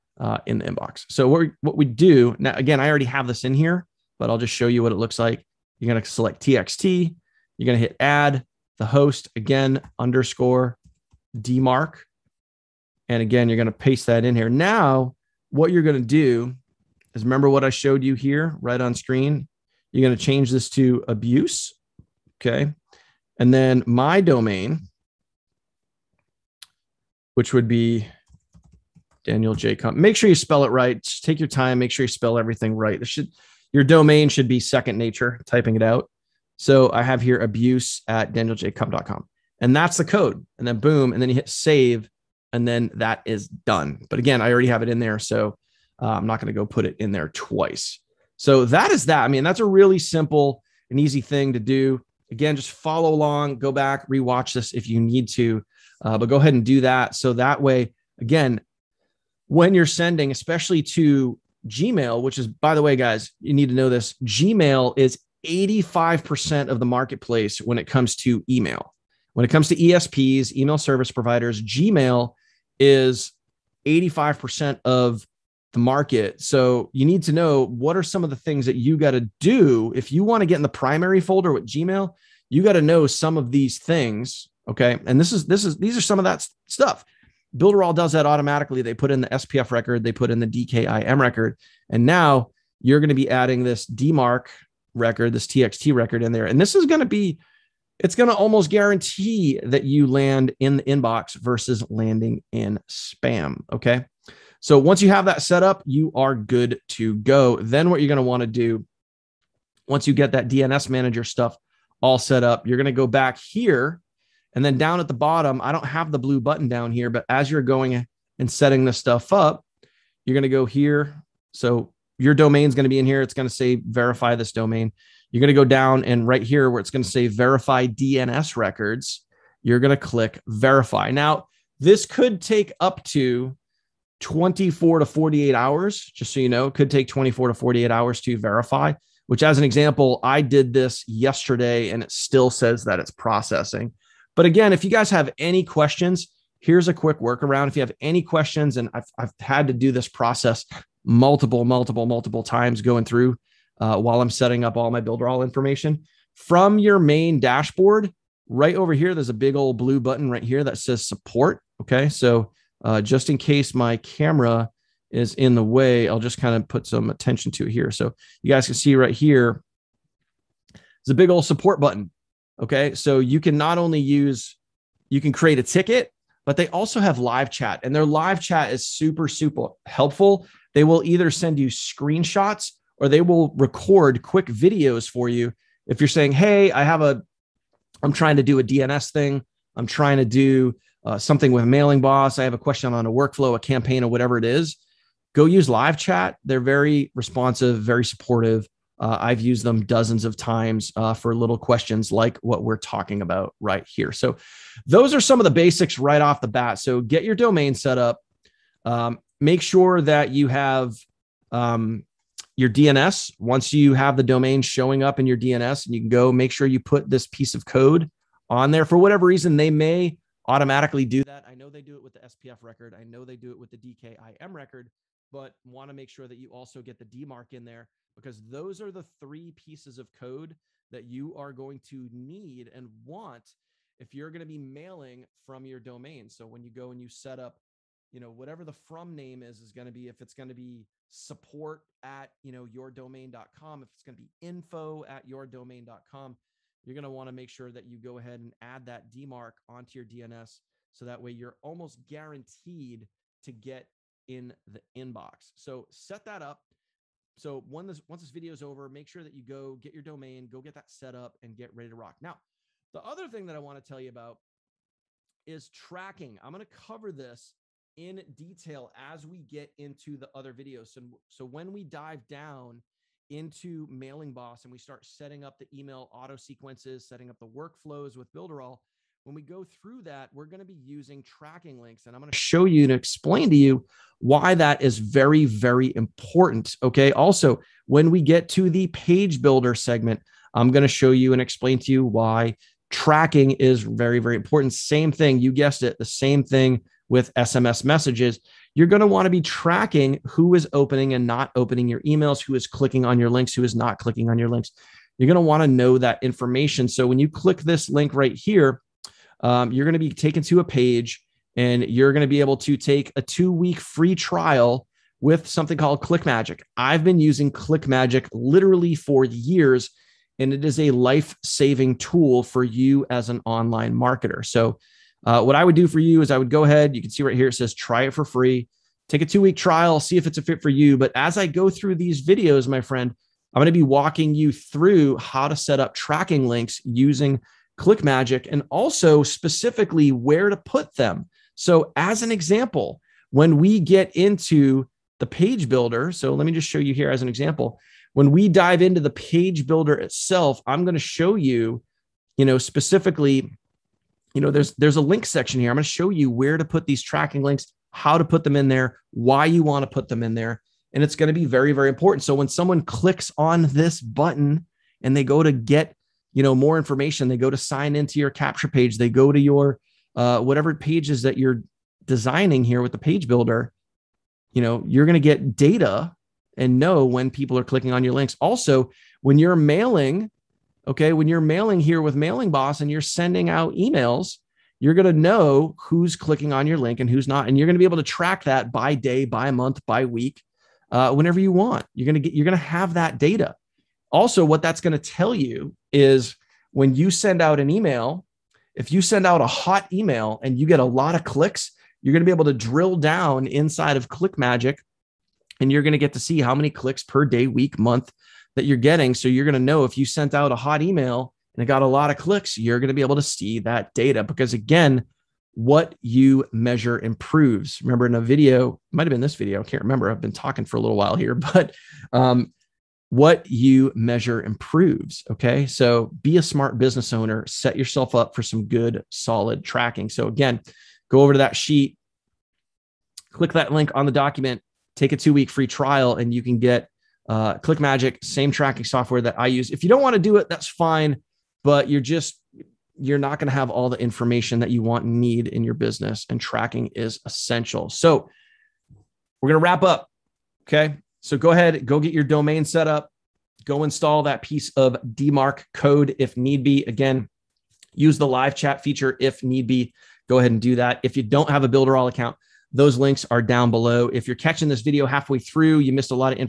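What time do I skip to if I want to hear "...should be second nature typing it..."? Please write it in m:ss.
0:34.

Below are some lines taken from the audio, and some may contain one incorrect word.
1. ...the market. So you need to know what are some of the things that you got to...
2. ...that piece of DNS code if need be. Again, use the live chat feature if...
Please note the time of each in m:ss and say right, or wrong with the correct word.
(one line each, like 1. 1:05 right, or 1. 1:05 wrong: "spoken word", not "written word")
1. 1:15 right
2. 7:34 wrong: "DMARC", not "DNS".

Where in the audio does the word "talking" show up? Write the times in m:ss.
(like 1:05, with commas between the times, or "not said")
3:22, 7:00.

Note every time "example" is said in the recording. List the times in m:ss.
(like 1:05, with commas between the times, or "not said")
2:19, 5:42, 5:47.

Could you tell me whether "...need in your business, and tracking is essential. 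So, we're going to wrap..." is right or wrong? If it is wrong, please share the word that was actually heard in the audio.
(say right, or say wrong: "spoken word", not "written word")
right.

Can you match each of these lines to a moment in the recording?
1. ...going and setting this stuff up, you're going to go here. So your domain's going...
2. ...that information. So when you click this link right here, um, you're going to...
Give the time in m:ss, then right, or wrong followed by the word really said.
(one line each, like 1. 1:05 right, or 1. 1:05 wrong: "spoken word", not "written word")
1. 1:57 right
2. 5:05 right.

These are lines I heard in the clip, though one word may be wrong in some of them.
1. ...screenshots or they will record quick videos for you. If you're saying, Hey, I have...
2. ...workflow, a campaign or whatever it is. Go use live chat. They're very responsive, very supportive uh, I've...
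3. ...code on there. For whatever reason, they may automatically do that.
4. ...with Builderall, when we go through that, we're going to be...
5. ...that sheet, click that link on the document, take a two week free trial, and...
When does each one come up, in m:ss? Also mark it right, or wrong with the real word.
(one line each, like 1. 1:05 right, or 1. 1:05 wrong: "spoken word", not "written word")
1. 3:01 right
2. 3:13 right
3. 3:37 right
4. 4:38 right
5. 7:11 right.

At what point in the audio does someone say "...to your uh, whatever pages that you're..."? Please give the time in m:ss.
6:09.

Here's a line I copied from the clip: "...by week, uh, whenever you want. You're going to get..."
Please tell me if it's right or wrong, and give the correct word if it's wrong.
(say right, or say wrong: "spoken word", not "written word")
right.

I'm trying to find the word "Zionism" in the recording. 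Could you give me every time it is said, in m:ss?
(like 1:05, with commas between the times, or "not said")
not said.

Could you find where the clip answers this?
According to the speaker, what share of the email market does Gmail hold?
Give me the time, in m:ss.
1:04.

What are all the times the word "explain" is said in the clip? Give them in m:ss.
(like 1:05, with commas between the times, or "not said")
4:42, 4:51.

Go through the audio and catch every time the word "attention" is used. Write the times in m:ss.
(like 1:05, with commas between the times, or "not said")
2:47.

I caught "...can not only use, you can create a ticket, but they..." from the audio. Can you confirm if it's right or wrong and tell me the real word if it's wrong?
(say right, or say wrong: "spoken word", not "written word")
right.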